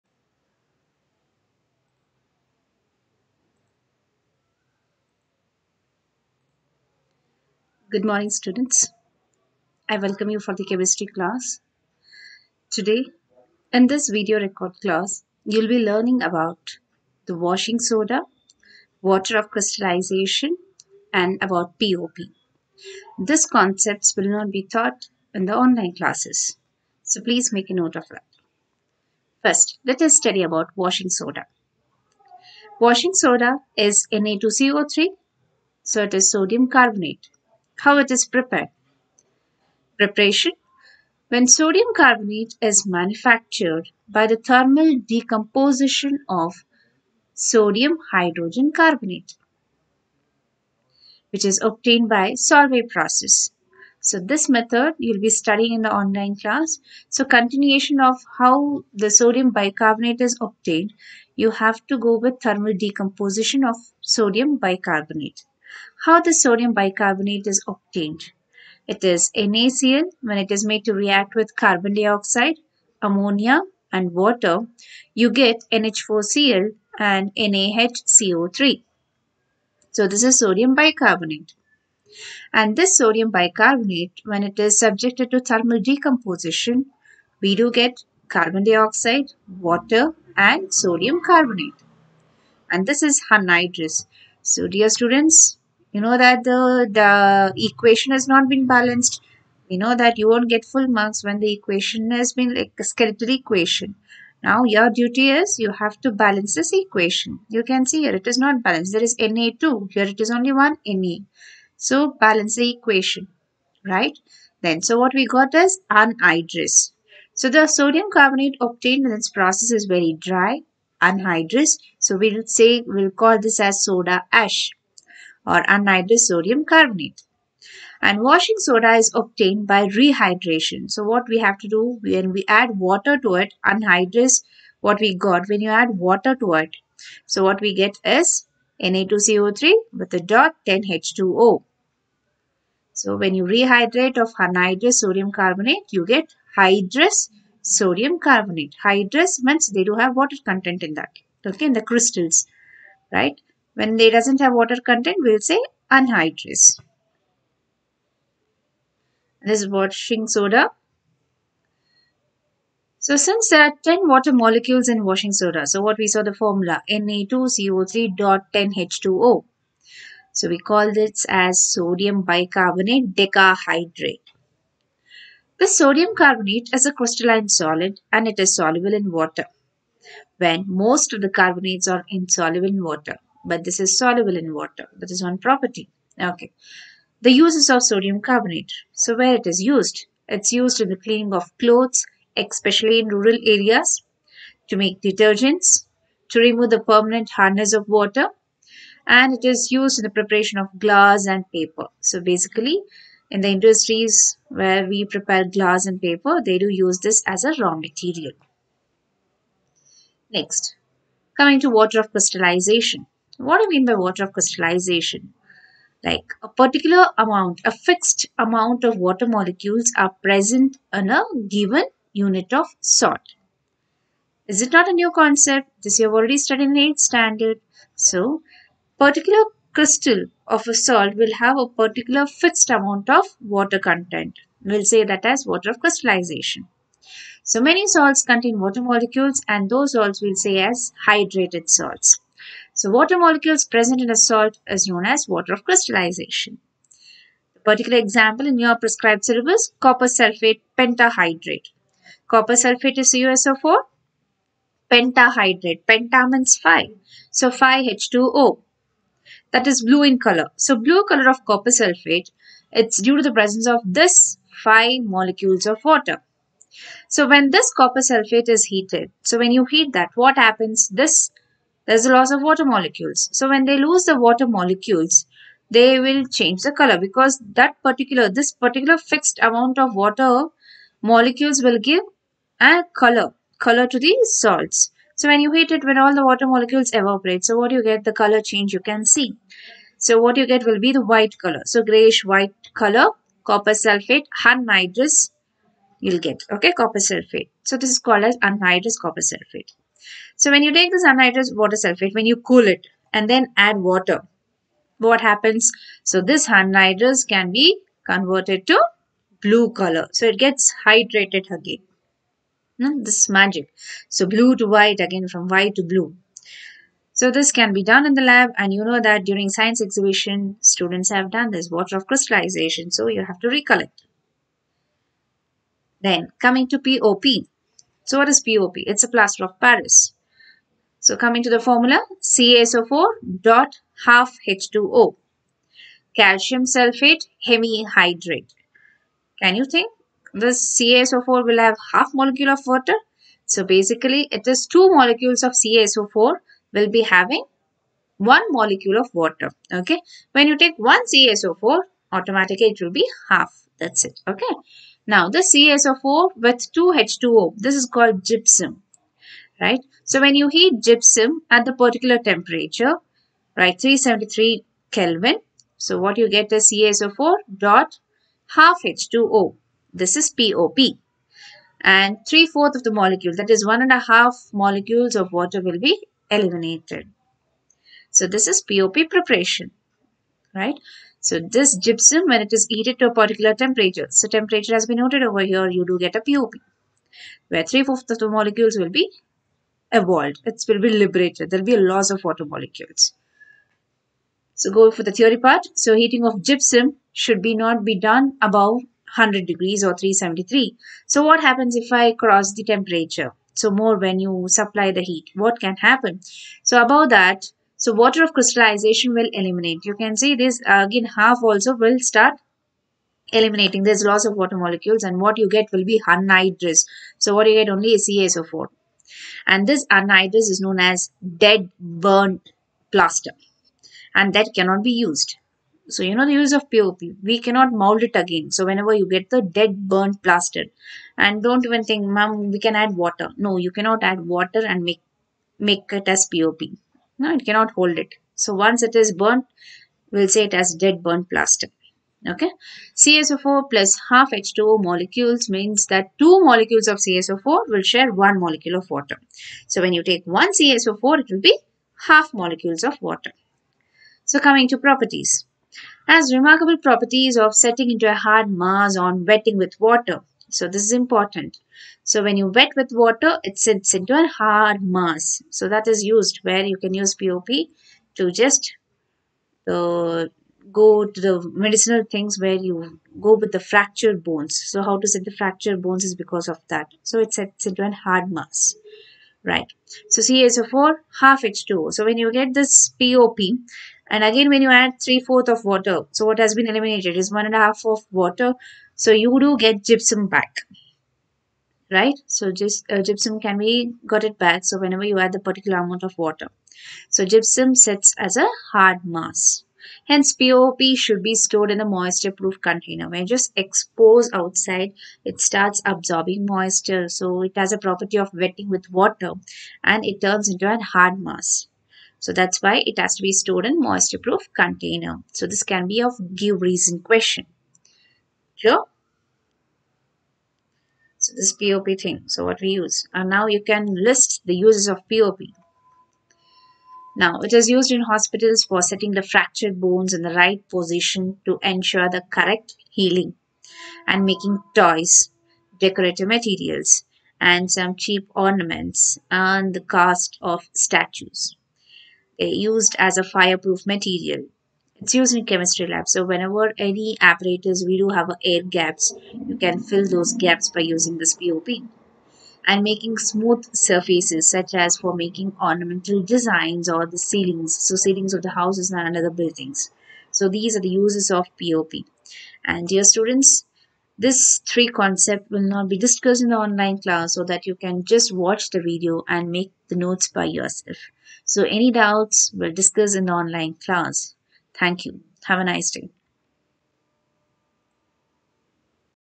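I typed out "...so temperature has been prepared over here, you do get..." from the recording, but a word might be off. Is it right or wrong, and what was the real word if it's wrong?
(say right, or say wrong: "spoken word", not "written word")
wrong: "noted", not "prepared".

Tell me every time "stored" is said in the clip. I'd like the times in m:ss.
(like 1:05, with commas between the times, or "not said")
8:21, 8:33.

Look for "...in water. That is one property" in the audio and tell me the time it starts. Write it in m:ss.
3:04.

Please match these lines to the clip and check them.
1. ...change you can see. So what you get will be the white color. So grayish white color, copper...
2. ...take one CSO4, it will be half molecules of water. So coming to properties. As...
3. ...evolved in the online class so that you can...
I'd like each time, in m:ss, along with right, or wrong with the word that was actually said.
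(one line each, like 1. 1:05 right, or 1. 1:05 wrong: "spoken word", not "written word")
1. 4:48 right
2. 7:30 right
3. 9:26 wrong: "discussed", not "evolved".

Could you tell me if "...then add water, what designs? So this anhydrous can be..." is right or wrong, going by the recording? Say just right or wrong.
wrong.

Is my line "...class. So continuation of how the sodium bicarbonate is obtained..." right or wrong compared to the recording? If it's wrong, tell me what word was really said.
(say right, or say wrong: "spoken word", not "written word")
right.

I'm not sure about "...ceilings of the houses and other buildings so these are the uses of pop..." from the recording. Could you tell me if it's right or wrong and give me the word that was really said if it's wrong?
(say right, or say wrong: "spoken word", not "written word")
right.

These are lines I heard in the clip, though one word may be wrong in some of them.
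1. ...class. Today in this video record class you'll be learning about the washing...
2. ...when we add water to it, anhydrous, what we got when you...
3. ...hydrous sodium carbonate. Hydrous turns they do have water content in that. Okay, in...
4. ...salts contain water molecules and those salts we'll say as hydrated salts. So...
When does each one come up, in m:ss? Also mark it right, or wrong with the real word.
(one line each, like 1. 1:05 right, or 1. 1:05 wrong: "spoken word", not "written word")
1. 0:11 right
2. 2:12 right
3. 2:26 wrong: "means", not "turns"
4. 3:57 right.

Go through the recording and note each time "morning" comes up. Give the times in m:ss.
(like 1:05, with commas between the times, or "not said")
0:08.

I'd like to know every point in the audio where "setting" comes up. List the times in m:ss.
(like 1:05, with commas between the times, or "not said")
7:37, 8:48.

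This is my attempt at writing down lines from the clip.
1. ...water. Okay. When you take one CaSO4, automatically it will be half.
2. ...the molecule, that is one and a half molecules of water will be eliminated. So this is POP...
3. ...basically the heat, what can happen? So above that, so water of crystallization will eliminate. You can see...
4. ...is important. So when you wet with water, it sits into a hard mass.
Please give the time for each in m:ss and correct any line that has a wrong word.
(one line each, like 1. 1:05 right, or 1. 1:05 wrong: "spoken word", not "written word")
1. 5:49 right
2. 6:12 right
3. 6:44 wrong: "supply", not "basically"
4. 7:40 right.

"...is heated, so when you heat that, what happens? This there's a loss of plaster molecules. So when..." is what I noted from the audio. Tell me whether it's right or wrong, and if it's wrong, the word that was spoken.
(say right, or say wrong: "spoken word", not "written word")
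wrong: "water", not "plaster".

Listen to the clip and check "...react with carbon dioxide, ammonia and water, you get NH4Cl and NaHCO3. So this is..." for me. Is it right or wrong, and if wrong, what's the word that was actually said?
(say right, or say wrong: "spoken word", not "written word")
right.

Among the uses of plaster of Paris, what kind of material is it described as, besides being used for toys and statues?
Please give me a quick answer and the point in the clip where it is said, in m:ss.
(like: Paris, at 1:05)
fireproof material, at 9:03.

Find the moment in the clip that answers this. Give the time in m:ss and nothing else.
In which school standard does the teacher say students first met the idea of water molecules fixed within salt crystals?
3:46.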